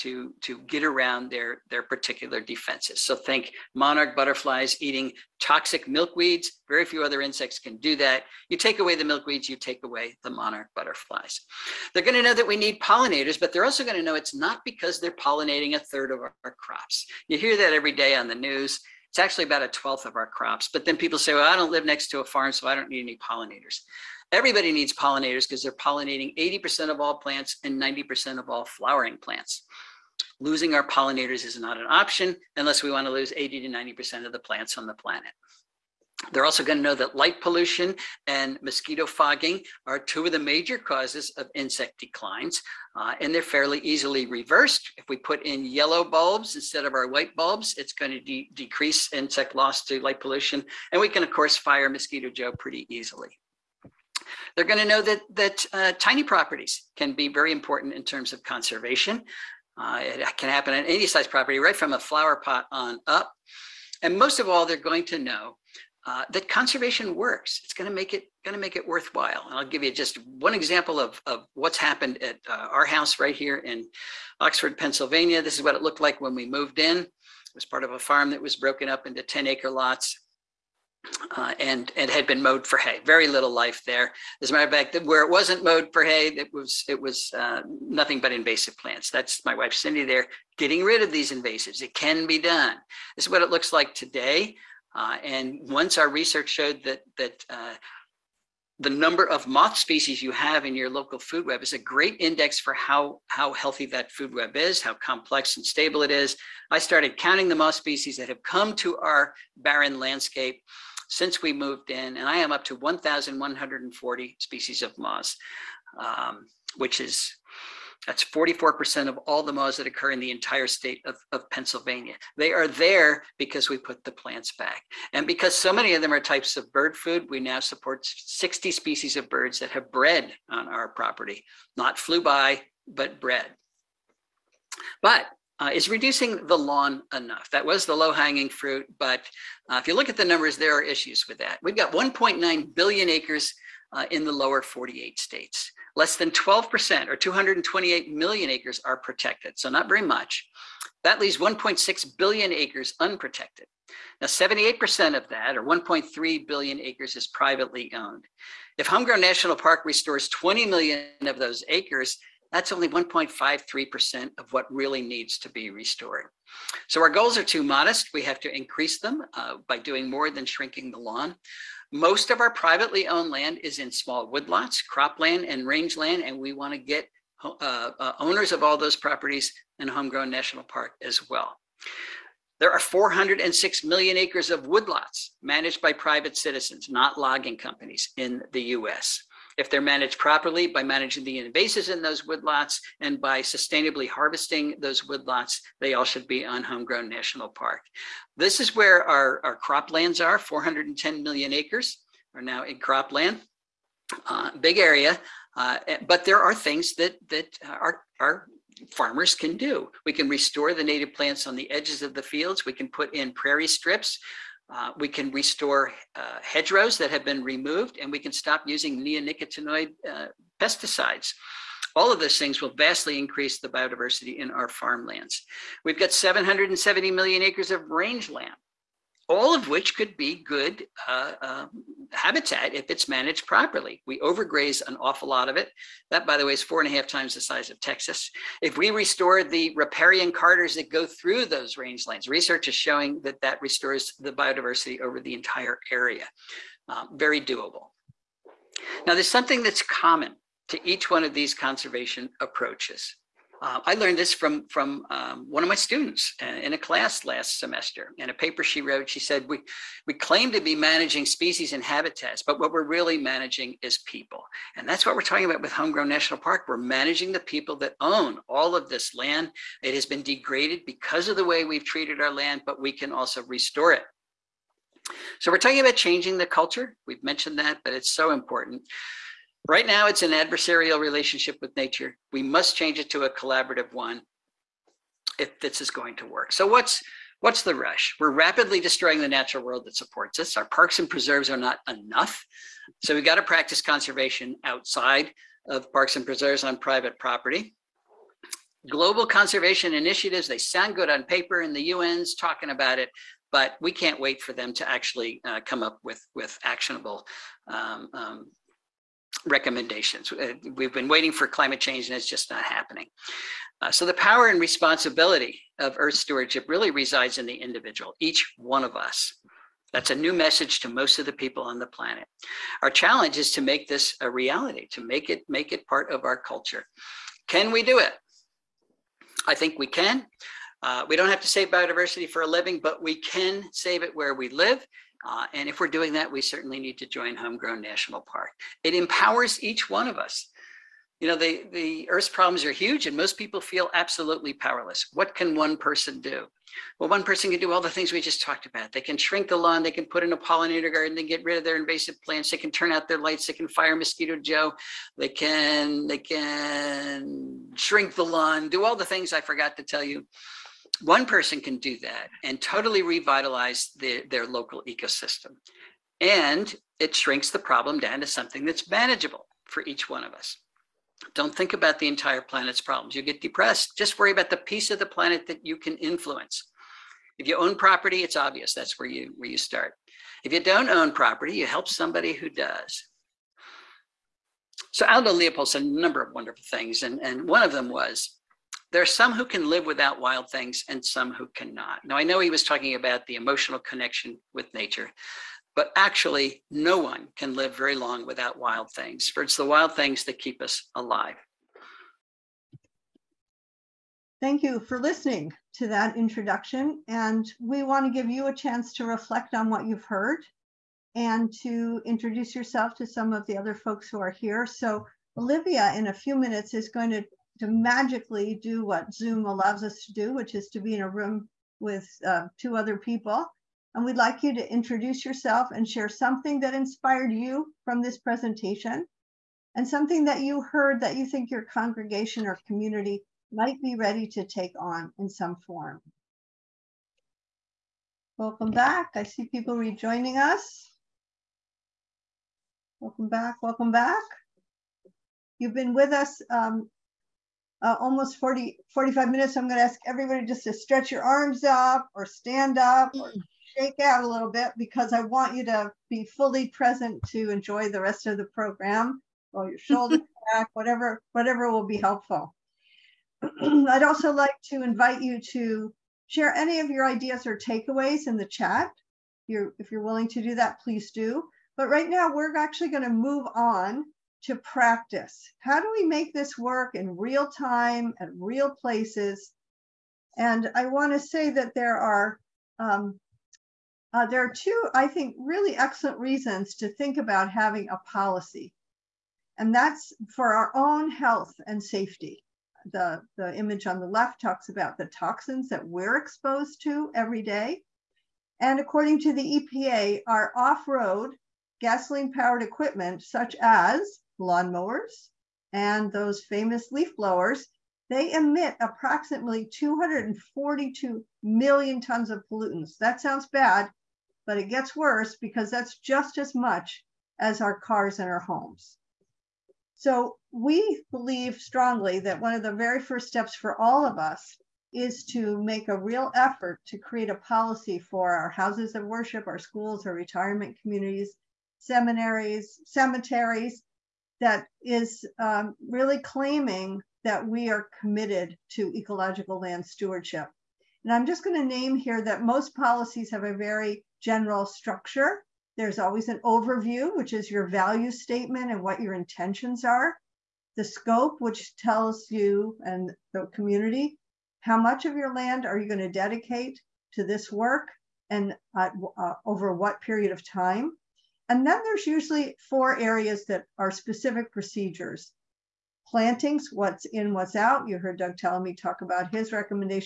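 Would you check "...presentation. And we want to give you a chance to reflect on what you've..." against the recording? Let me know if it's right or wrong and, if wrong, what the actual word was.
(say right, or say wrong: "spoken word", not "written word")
wrong: "introduction", not "presentation".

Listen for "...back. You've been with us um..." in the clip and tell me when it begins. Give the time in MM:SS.
07:23.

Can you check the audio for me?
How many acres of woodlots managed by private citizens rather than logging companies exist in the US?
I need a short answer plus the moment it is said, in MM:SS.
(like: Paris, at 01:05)
406 million acres, at 03:02.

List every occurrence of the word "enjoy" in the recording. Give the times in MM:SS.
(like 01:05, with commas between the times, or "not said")
07:37.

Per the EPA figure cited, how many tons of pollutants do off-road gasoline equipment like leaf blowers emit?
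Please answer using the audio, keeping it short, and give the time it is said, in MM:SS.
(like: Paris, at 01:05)
242 million tons, at 08:29.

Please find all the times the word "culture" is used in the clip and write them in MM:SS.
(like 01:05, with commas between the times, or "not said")
04:36, 05:26.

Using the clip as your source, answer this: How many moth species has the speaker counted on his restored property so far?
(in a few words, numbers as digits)
1,140.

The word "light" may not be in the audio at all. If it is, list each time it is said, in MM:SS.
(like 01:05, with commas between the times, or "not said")
00:37, 00:49, 05:53.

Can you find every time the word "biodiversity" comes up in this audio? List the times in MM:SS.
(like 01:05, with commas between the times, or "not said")
03:43, 04:04, 05:31.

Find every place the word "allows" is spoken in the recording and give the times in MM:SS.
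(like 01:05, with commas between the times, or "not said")
06:59.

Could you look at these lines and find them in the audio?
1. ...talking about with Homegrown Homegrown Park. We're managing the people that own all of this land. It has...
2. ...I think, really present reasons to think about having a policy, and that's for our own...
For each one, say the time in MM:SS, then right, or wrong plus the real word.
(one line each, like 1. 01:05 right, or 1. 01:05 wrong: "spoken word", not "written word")
1. 04:25 wrong: "National", not "Homegrown"
2. 08:04 wrong: "excellent", not "present".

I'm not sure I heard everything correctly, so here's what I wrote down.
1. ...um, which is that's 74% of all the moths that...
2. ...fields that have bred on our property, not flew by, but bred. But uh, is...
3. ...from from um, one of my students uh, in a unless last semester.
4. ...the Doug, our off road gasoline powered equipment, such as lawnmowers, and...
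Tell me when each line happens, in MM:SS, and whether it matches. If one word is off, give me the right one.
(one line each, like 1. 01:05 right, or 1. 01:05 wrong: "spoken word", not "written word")
1. 01:55 wrong: "44", not "74"
2. 02:09 wrong: "birds", not "fields"
3. 04:14 wrong: "class", not "unless"
4. 08:19 wrong: "EPA", not "Doug".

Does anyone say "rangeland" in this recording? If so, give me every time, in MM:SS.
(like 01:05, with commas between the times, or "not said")
02:55, 03:47, 04:01.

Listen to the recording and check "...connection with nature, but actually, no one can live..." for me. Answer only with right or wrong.
right.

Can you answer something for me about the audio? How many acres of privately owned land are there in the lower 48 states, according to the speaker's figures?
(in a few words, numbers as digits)
1.3 billion acres.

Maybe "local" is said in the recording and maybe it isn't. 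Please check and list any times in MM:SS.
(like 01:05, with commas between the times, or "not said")
01:40, 06:04.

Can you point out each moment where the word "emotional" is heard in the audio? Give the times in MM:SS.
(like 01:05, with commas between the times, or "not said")
06:33.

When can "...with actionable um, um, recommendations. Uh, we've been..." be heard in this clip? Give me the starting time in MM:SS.
05:06.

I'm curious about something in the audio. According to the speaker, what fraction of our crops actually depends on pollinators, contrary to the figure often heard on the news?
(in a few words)
a twelfth.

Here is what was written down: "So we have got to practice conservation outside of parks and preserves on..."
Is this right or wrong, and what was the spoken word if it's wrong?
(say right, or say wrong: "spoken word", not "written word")
right.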